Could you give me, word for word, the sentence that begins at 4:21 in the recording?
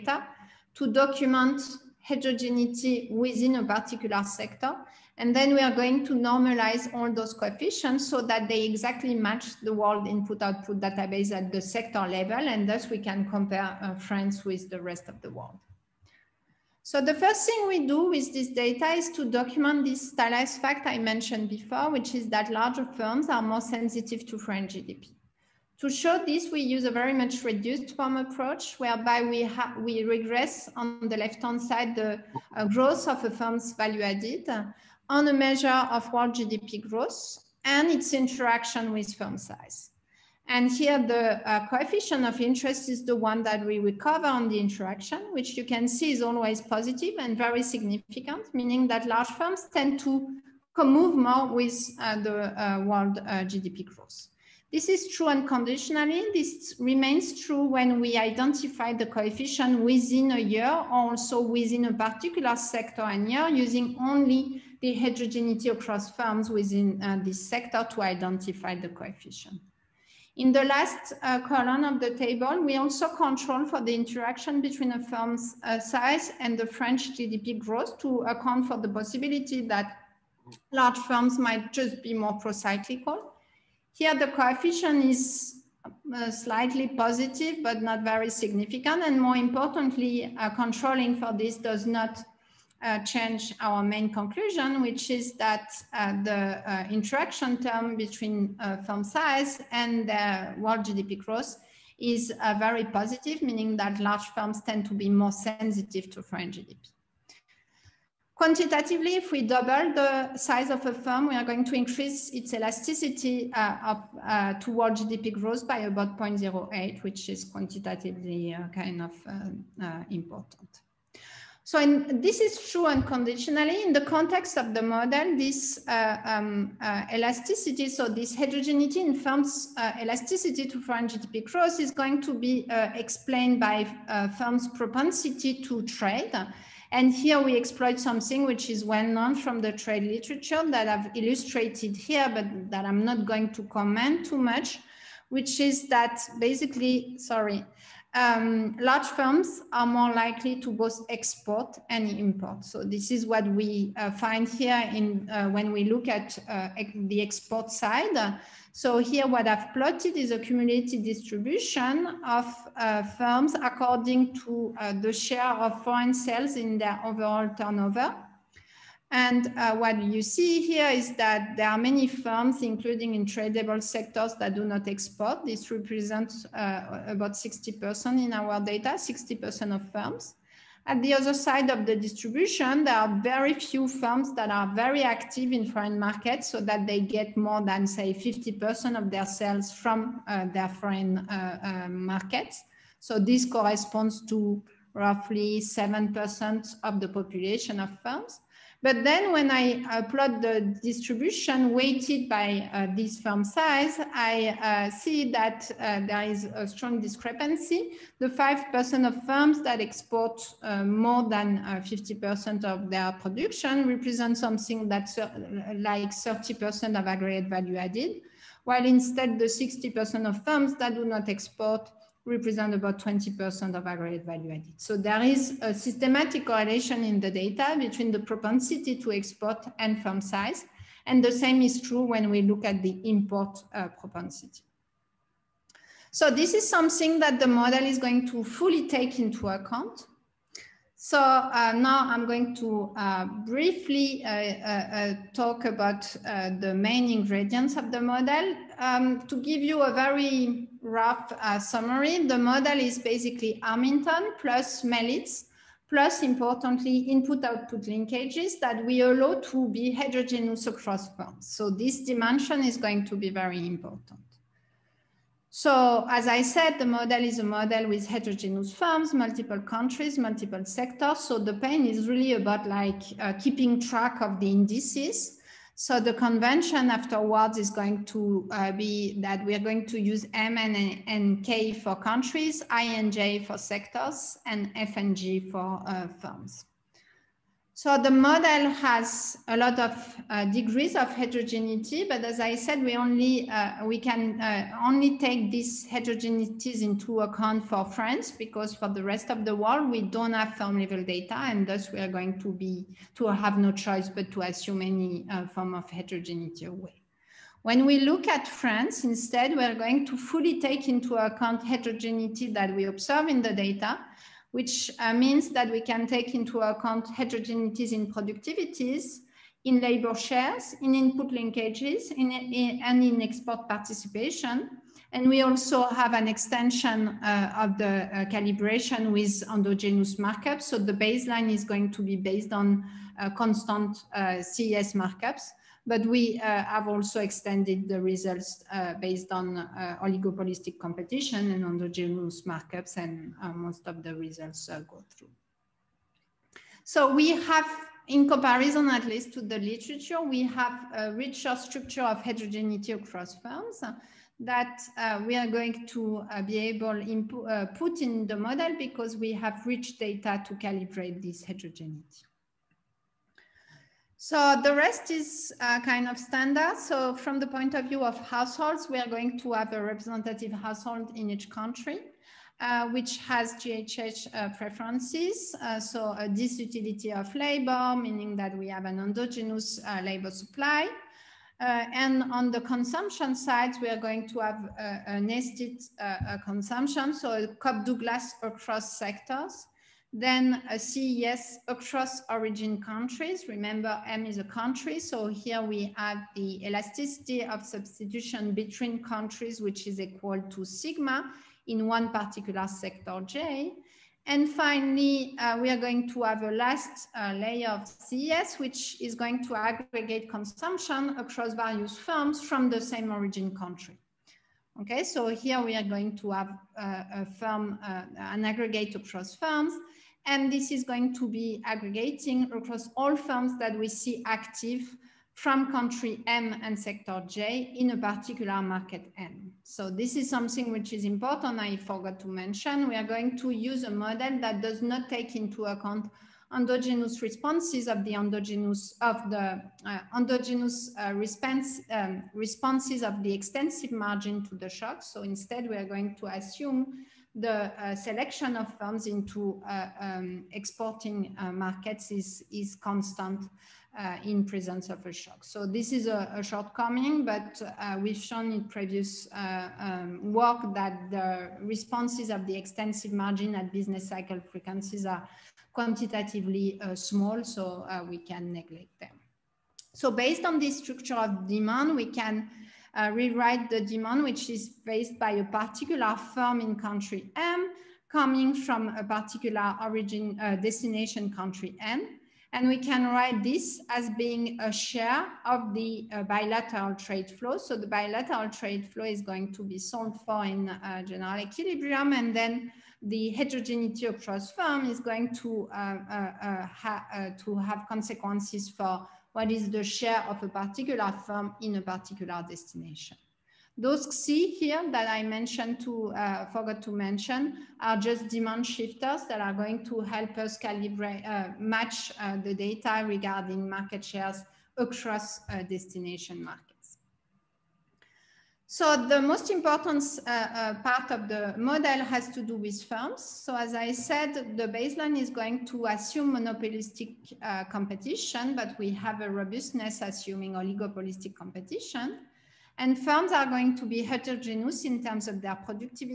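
So this dimension is going to be very important.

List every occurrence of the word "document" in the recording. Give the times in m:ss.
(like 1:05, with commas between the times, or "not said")
0:00, 0:19.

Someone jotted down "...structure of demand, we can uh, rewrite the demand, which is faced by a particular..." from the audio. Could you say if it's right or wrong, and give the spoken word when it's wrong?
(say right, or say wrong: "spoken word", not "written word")
right.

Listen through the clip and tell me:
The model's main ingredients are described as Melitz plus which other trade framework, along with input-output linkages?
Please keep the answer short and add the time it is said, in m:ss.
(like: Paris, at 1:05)
Armington, at 4:13.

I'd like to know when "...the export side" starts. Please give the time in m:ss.
2:36.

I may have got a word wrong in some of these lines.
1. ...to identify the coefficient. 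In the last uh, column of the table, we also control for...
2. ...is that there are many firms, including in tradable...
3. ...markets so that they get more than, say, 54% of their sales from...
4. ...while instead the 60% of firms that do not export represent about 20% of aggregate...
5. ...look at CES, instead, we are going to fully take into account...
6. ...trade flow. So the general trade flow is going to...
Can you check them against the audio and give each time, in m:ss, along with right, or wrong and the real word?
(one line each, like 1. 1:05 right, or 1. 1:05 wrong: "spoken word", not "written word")
1. 1:07 right
2. 2:50 right
3. 3:05 wrong: "50", not "54"
4. 3:38 right
5. 5:07 wrong: "France", not "CES"
6. 8:06 wrong: "bilateral", not "general".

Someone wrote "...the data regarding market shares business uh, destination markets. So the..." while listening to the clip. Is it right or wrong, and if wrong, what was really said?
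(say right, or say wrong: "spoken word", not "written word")
wrong: "across", not "business".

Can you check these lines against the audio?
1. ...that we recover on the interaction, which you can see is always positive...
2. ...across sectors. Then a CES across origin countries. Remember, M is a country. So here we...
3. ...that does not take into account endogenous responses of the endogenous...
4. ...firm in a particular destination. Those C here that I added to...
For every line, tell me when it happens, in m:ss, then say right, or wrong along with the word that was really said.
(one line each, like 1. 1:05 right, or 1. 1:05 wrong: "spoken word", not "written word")
1. 0:43 right
2. 6:28 right
3. 7:14 right
4. 8:21 wrong: "mentioned", not "added".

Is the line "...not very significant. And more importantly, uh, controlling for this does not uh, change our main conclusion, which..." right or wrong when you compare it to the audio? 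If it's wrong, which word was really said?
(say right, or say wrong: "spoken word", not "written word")
right.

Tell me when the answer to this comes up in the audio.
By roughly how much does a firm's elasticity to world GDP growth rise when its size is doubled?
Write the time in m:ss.
1:56.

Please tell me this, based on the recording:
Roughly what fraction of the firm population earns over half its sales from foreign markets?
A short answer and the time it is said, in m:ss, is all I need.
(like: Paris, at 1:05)
7%, at 3:15.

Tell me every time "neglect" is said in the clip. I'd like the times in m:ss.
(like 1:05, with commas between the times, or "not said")
7:48.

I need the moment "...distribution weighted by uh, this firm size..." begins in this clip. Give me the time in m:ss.
3:20.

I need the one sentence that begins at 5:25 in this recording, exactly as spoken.
And we also have an extension uh, of the uh, calibration with endogenous markups.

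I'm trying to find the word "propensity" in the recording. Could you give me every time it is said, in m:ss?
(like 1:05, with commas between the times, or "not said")
2:14, 3:48, 3:53.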